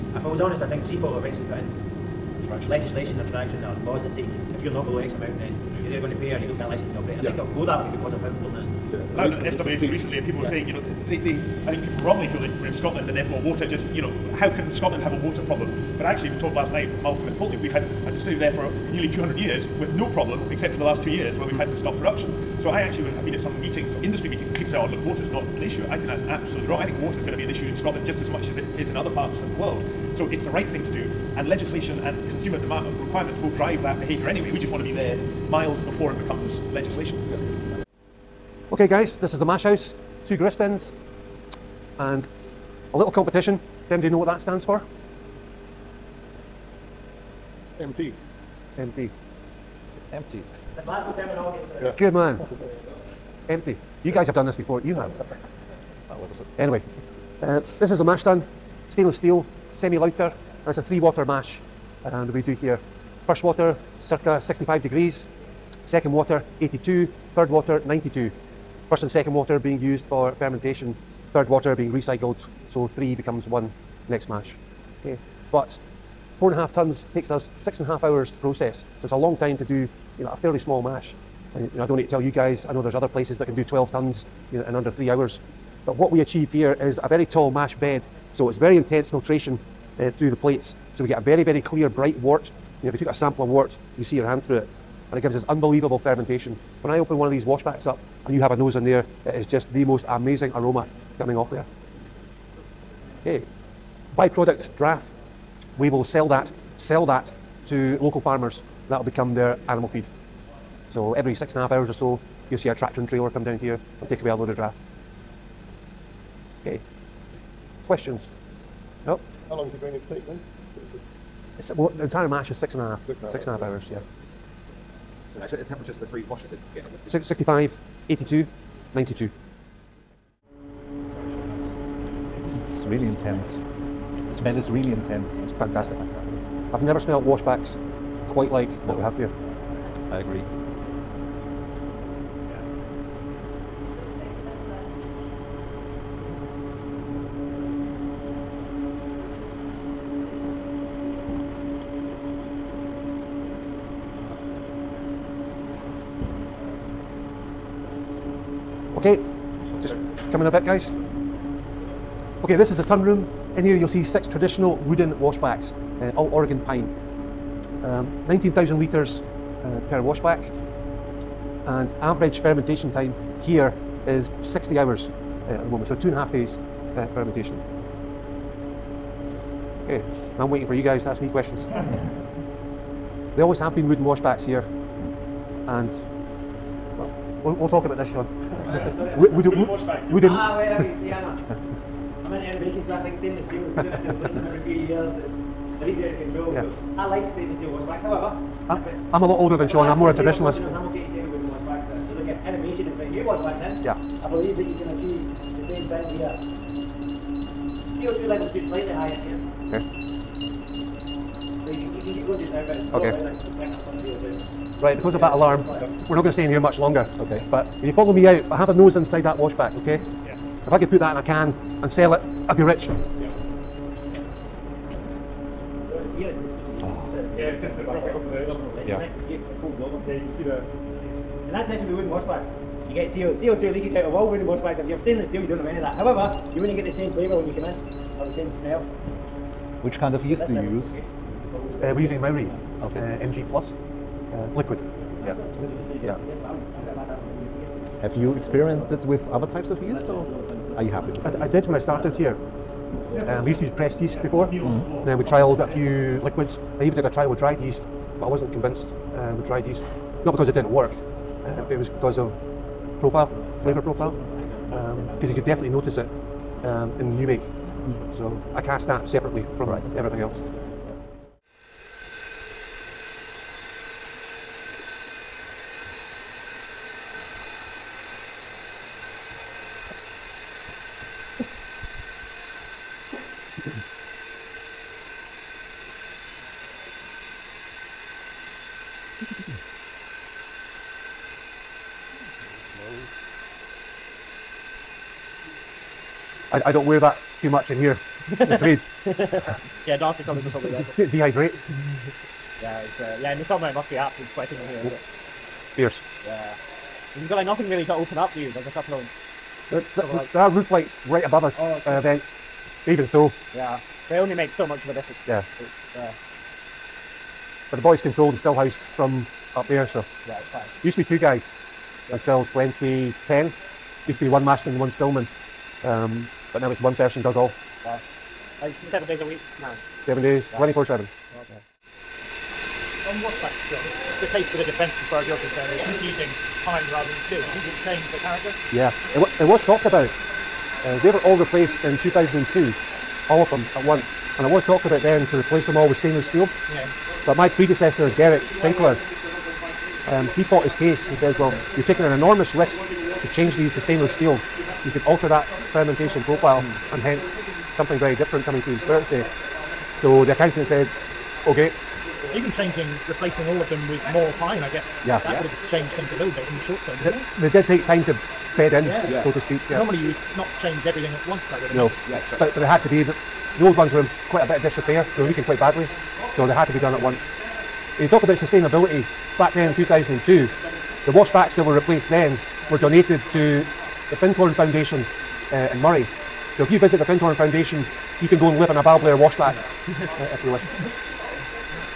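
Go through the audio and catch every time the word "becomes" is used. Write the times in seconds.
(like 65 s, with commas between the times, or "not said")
36 s, 73 s, 109 s.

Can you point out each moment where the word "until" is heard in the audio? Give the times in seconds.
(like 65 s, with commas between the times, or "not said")
322 s.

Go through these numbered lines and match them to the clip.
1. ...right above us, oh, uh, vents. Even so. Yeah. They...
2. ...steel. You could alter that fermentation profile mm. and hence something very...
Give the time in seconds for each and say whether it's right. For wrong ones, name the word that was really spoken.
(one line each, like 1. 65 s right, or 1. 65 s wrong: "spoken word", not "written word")
1. 311 s right
2. 354 s right.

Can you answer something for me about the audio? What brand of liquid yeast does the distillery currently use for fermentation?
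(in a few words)
Mauri.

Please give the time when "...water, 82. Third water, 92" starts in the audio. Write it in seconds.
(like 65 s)
66 s.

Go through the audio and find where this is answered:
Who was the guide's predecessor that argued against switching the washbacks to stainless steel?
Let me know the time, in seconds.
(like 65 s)
348 s.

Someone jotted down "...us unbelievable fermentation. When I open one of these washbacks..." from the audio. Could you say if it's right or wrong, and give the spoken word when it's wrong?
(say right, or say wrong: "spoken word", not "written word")
right.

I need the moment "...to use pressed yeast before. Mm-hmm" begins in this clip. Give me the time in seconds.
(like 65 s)
253 s.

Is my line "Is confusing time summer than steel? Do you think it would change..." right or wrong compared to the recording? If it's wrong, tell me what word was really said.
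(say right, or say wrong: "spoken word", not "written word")
wrong: "rather", not "summer".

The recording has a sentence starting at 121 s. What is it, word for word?
It's, well, the entire mash is six and a half.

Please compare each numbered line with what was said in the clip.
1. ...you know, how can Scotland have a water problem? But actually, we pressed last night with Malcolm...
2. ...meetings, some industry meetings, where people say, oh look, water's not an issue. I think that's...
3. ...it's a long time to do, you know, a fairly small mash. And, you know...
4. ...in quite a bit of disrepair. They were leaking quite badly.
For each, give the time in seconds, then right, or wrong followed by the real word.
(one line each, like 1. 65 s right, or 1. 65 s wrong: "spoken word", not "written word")
1. 13 s wrong: "talked", not "pressed"
2. 23 s right
3. 79 s right
4. 374 s right.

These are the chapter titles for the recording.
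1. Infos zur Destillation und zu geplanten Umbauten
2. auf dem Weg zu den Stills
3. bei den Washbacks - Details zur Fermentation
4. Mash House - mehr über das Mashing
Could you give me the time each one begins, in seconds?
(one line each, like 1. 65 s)
1. 331 s
2. 271 s
3. 130 s
4. 37 s.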